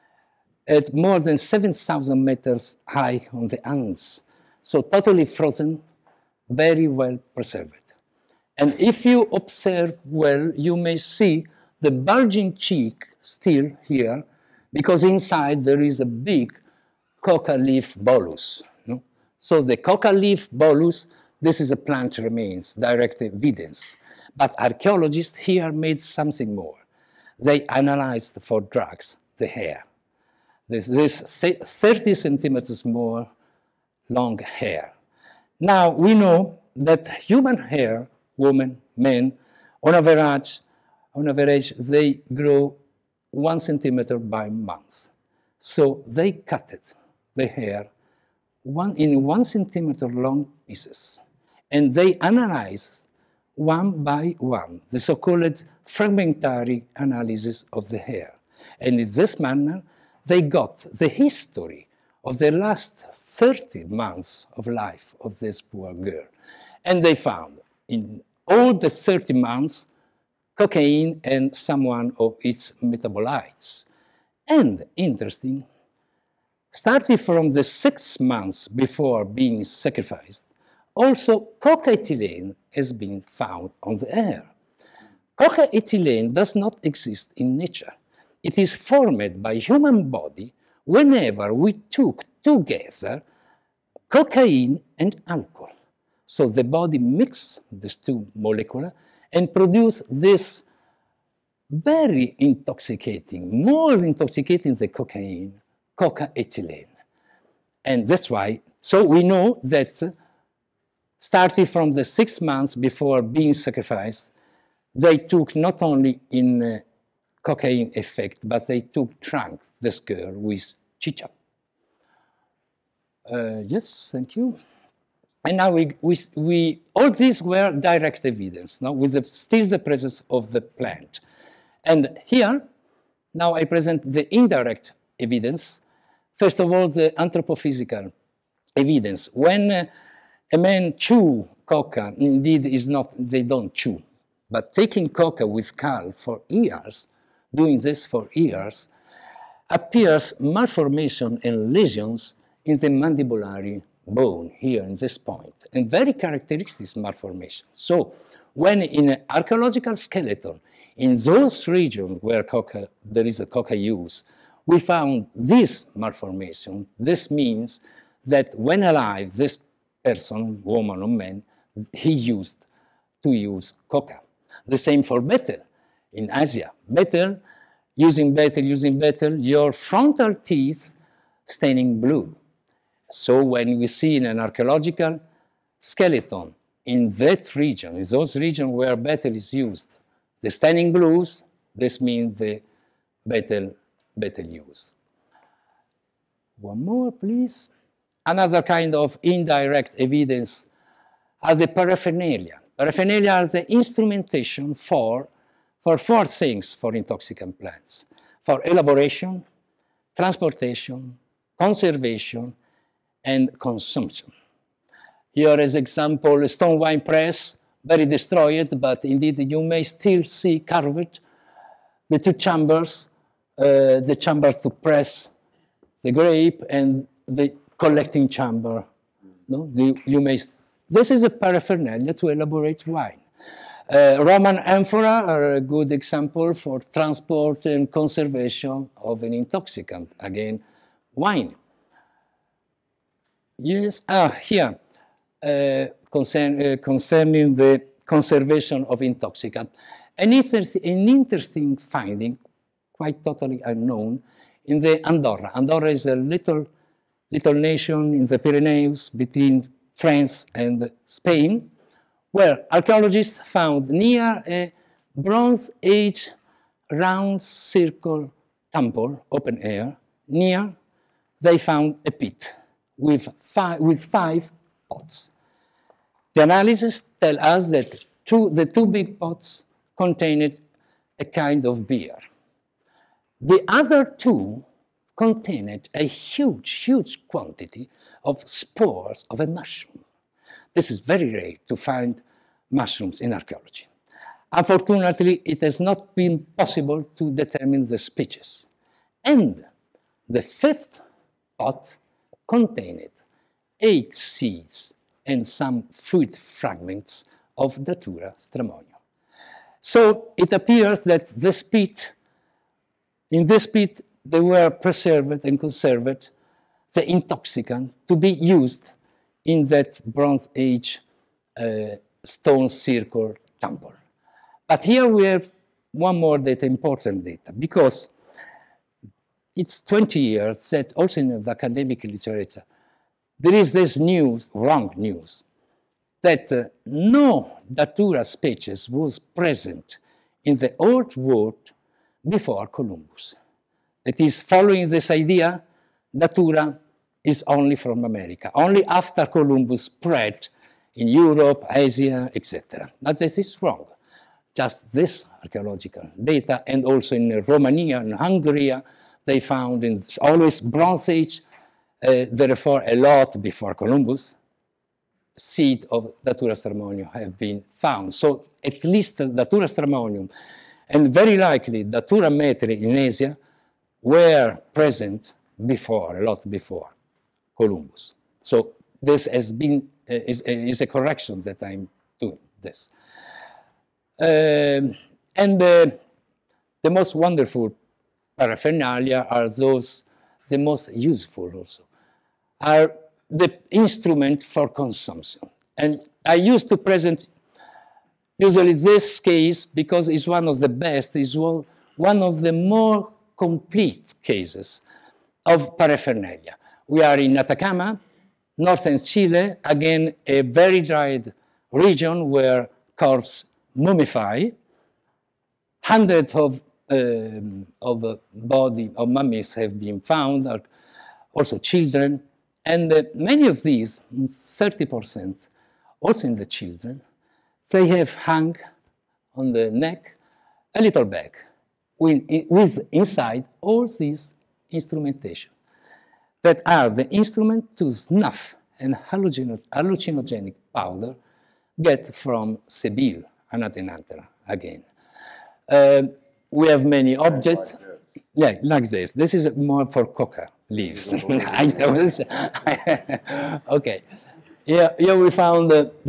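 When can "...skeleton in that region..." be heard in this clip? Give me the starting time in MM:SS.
03:05.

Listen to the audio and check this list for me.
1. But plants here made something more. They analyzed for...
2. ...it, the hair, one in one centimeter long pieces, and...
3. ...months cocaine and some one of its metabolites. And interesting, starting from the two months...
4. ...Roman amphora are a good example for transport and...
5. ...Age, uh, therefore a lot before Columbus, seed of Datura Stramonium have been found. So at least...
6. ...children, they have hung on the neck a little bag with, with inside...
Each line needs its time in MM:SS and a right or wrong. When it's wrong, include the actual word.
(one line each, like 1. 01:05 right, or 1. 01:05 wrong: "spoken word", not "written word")
1. 00:24 wrong: "archaeologists", not "plants"
2. 00:46 right
3. 01:09 wrong: "six", not "two"
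4. 03:54 right
5. 06:01 right
6. 07:06 right.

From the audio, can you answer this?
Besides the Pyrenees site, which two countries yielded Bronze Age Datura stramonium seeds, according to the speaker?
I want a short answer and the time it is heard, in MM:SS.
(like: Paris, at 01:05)
Romania and Hungary, at 05:57.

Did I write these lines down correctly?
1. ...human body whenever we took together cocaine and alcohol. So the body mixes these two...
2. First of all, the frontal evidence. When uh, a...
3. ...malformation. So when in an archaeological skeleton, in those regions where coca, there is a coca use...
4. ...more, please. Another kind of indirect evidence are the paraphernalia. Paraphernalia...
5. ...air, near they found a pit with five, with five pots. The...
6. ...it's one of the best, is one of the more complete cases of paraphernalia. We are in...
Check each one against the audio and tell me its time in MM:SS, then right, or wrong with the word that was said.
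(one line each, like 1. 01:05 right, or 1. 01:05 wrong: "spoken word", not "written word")
1. 01:29 right
2. 02:16 wrong: "anthropophysical", not "frontal"
3. 02:36 right
4. 03:16 right
5. 04:29 right
6. 06:40 right.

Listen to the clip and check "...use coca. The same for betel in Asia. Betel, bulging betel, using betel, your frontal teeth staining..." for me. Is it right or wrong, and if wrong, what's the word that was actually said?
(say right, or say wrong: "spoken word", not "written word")
wrong: "using", not "bulging".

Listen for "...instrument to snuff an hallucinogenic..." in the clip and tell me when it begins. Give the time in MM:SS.
07:17.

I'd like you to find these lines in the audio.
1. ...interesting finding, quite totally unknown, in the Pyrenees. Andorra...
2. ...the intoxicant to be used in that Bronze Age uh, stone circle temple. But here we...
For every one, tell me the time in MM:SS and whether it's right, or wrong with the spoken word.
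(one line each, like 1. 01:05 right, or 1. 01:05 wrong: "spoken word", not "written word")
1. 04:11 wrong: "Andorra", not "Pyrenees"
2. 05:16 right.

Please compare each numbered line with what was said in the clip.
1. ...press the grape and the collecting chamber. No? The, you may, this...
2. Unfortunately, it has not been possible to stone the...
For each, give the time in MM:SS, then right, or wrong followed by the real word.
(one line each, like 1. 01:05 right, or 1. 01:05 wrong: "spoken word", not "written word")
1. 03:44 right
2. 04:54 wrong: "determine", not "stone".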